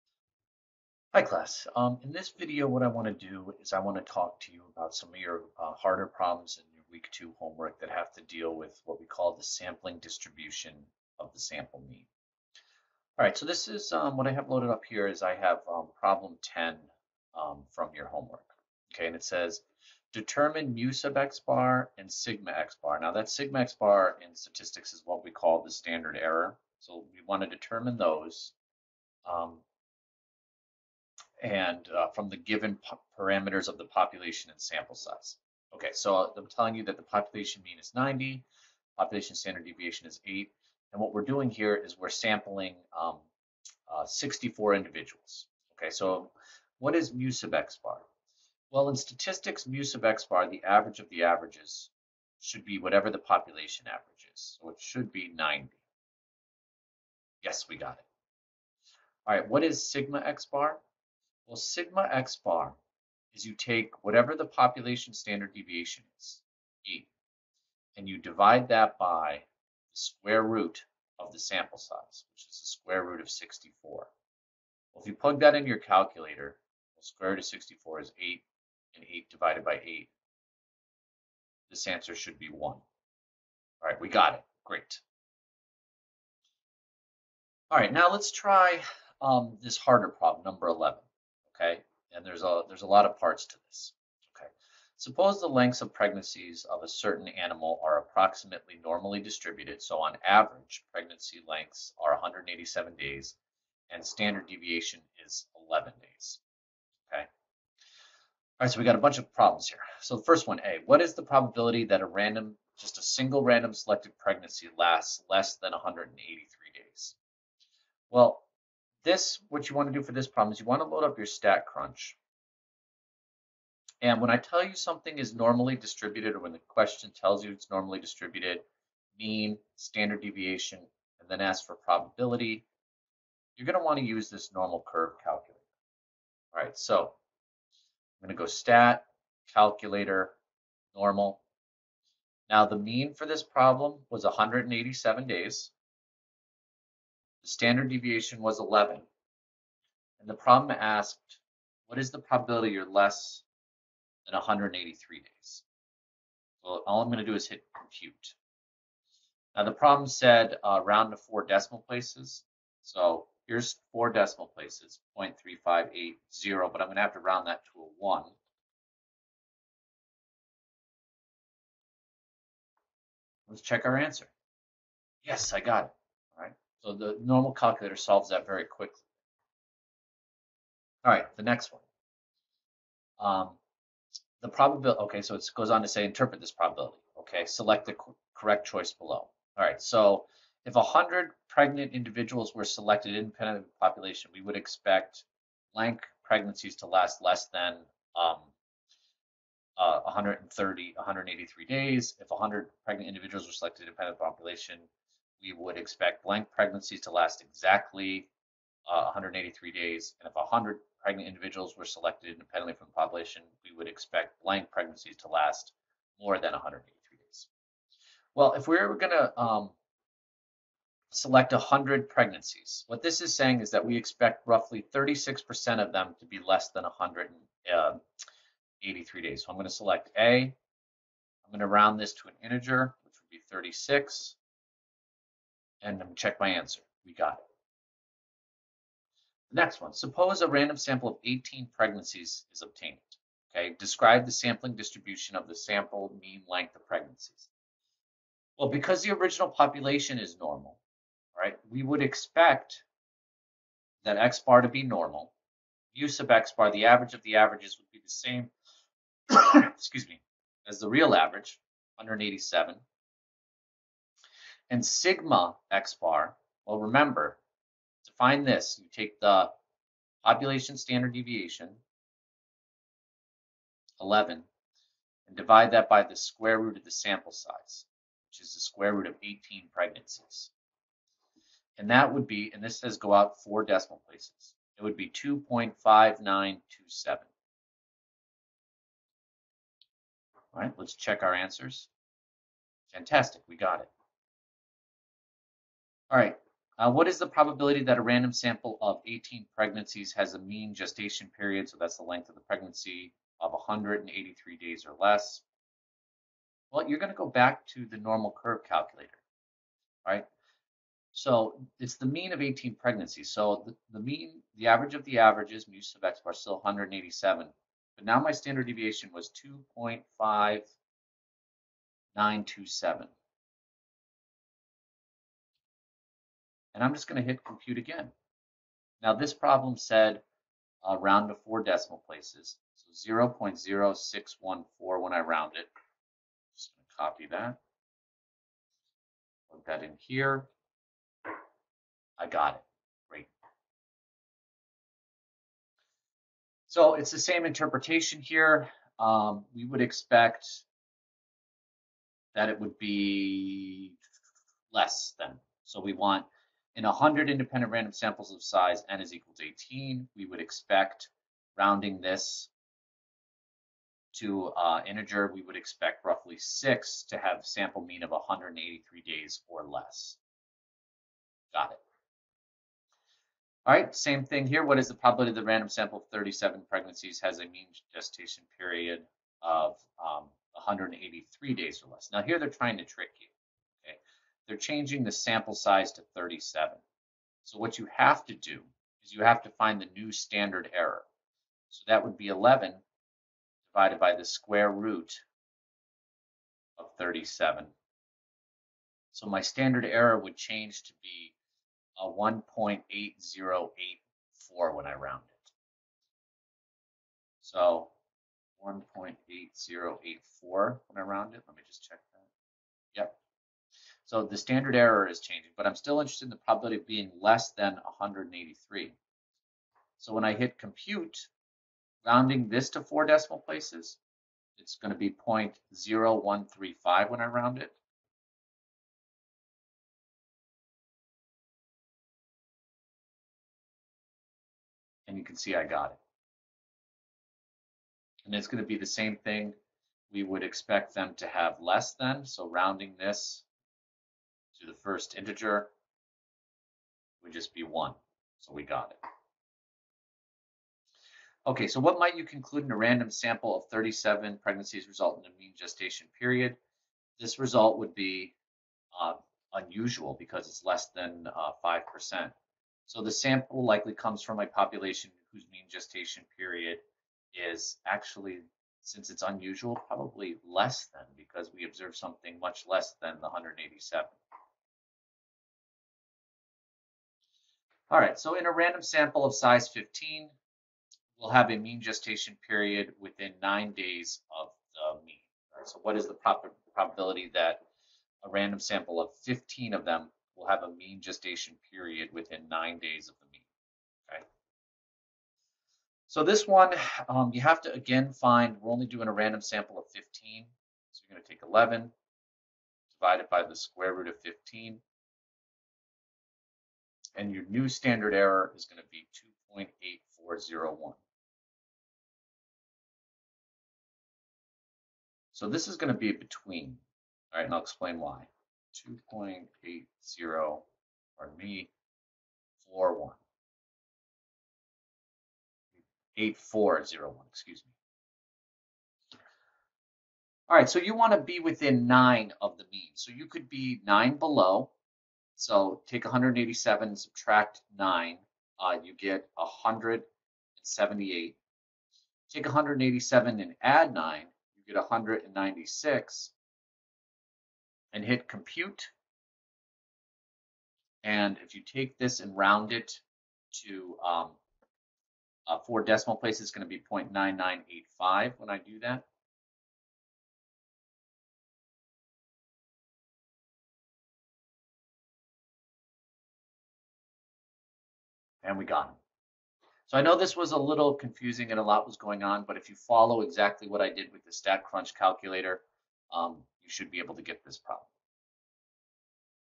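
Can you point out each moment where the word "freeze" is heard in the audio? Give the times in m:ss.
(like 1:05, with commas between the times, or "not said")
not said.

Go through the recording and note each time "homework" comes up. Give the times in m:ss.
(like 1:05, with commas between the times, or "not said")
0:07, 0:18.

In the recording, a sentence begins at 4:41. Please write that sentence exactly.
And that would be, and this says go out four decimal places, it would be 2.5927.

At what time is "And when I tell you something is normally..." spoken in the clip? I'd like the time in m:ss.
2:04.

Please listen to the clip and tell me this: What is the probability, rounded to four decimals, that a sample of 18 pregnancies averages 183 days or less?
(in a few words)
0.0614.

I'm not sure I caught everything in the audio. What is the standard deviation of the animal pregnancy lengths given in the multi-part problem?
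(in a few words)
11 days.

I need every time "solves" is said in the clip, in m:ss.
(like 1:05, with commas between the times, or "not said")
2:57.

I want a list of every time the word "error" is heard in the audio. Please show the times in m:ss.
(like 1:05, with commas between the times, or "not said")
0:26, 6:30, 6:39, 6:54, 8:28.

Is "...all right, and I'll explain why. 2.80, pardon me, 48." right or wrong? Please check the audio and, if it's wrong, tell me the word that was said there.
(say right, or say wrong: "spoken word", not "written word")
wrong: "41", not "48".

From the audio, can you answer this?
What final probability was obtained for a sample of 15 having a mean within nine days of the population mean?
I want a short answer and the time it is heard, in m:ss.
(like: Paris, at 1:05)
0.9985, at 9:17.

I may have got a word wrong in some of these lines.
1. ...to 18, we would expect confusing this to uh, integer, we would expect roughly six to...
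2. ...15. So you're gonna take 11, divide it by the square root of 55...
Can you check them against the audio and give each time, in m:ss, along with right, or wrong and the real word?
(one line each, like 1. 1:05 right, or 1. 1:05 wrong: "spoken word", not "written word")
1. 5:59 wrong: "rounding", not "confusing"
2. 8:19 wrong: "15", not "55".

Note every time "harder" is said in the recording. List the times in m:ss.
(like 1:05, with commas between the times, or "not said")
0:05, 1:29.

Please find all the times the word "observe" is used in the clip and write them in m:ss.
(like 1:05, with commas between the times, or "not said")
7:51.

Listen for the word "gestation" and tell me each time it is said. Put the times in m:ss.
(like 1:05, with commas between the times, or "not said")
5:00, 6:17, 7:35, 7:45, 8:01, 8:11.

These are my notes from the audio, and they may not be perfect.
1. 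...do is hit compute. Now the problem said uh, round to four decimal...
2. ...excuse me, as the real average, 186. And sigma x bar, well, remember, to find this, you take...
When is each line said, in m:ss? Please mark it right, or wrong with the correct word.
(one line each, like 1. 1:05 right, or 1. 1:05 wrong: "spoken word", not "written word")
1. 2:37 right
2. 4:19 wrong: "187", not "186".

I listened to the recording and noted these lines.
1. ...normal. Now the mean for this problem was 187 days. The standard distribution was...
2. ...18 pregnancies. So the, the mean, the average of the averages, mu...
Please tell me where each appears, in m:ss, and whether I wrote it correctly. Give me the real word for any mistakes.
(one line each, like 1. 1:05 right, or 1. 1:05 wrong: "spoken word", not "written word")
1. 2:20 wrong: "deviation", not "distribution"
2. 5:12 right.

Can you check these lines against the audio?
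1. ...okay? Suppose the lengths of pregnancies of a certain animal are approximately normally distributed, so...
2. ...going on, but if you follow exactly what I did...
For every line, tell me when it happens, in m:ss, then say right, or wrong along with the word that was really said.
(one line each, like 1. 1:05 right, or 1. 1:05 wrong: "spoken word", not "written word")
1. 1:34 right
2. 9:31 right.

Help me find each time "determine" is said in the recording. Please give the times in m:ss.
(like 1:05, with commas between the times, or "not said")
0:20, 0:27.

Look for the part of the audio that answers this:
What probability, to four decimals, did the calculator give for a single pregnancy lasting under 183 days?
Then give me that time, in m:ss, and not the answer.
2:45.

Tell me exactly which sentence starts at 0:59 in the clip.
All right, what is sigma x bar?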